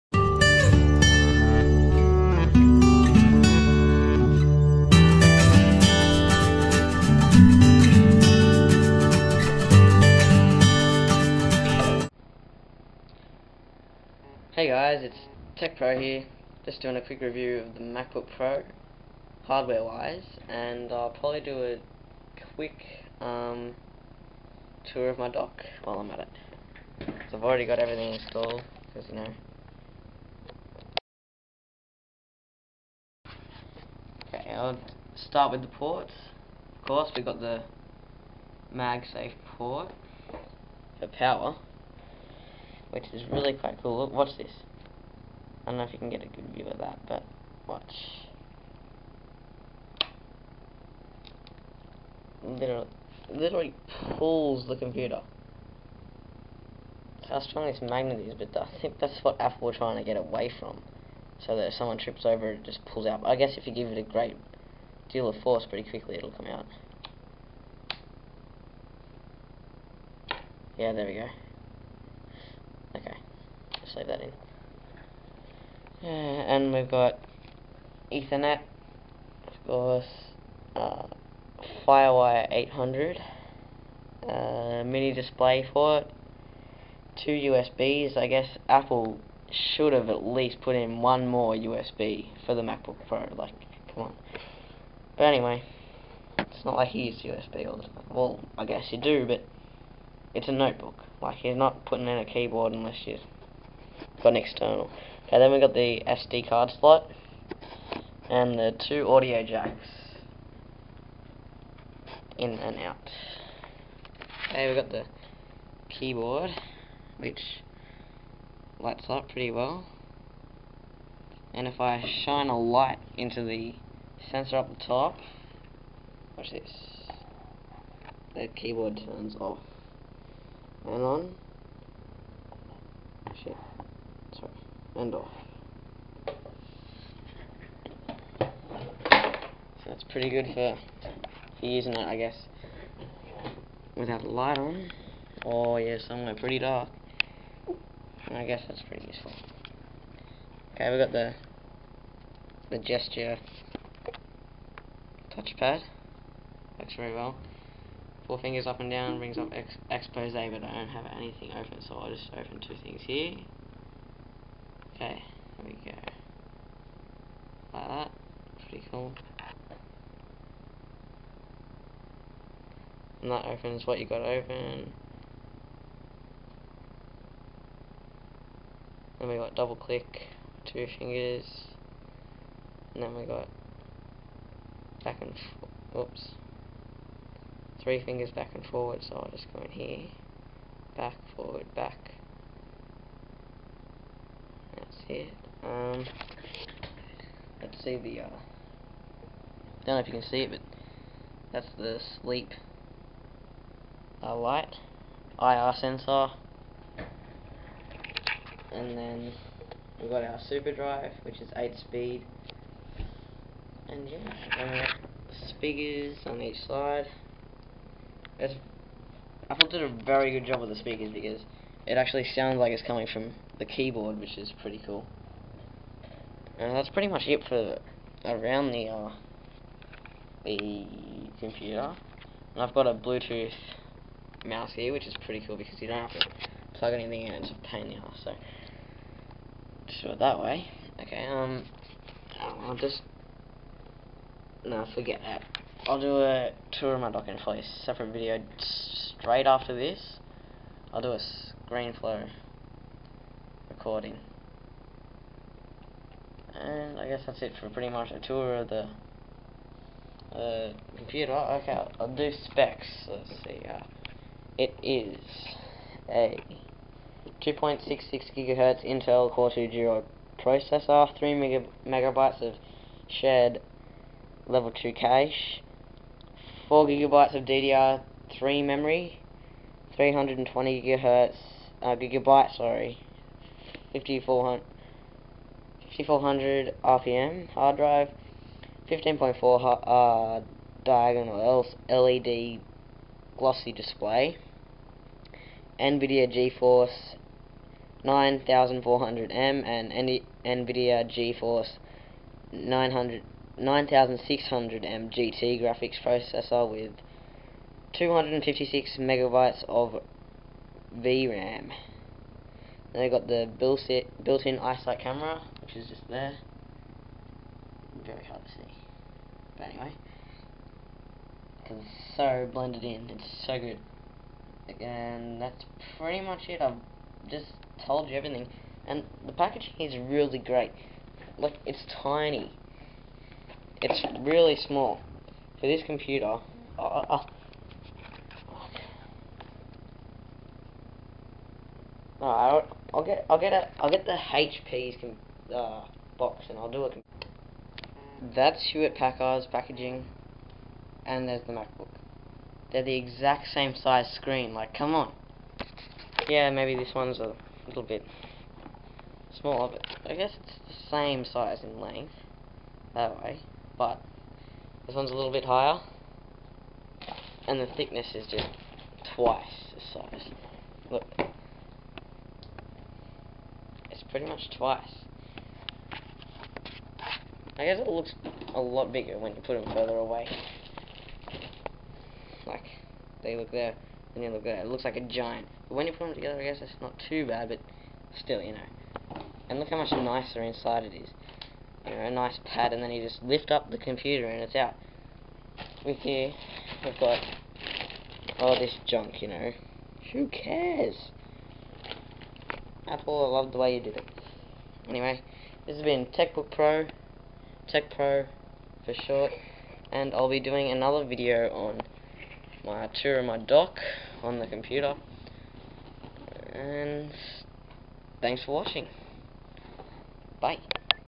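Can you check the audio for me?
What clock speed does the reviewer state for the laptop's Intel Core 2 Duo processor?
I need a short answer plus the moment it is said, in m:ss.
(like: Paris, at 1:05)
2.66 gigahertz, at 4:27.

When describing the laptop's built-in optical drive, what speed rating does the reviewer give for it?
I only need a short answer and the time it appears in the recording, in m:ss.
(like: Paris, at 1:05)
8 speed, at 3:31.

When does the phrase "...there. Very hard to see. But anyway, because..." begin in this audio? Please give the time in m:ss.
5:16.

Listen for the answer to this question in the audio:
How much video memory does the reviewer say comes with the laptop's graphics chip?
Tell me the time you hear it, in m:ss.
5:07.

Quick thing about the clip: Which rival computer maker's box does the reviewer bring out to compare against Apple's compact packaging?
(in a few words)
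Hewlett Packard.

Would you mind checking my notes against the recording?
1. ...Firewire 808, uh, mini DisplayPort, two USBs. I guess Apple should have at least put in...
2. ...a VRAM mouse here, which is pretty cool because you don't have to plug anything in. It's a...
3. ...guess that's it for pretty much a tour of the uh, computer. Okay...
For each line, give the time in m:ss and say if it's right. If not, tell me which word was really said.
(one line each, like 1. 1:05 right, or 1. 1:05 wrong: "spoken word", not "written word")
1. 1:21 wrong: "800", not "808"
2. 3:52 wrong: "Bluetooth", not "VRAM"
3. 4:17 right.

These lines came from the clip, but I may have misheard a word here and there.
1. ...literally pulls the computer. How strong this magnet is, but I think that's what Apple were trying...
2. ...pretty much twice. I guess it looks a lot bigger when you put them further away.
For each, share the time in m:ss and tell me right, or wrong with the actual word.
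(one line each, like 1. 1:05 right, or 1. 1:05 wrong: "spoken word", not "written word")
1. 0:53 right
2. 6:14 right.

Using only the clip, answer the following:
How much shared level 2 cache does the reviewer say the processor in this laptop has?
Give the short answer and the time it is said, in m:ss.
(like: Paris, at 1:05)
3 megabytes, at 4:31.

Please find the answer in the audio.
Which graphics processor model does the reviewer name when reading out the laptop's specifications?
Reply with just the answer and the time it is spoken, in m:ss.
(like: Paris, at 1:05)
9600M GT, at 5:03.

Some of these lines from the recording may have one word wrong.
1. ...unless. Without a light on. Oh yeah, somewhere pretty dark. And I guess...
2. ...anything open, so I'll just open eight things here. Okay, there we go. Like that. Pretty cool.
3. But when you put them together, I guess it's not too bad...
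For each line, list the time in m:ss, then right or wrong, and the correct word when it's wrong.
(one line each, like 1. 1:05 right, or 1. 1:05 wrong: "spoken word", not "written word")
1. 2:22 wrong: "guess", not "unless"
2. 2:41 wrong: "two", not "eight"
3. 6:25 right.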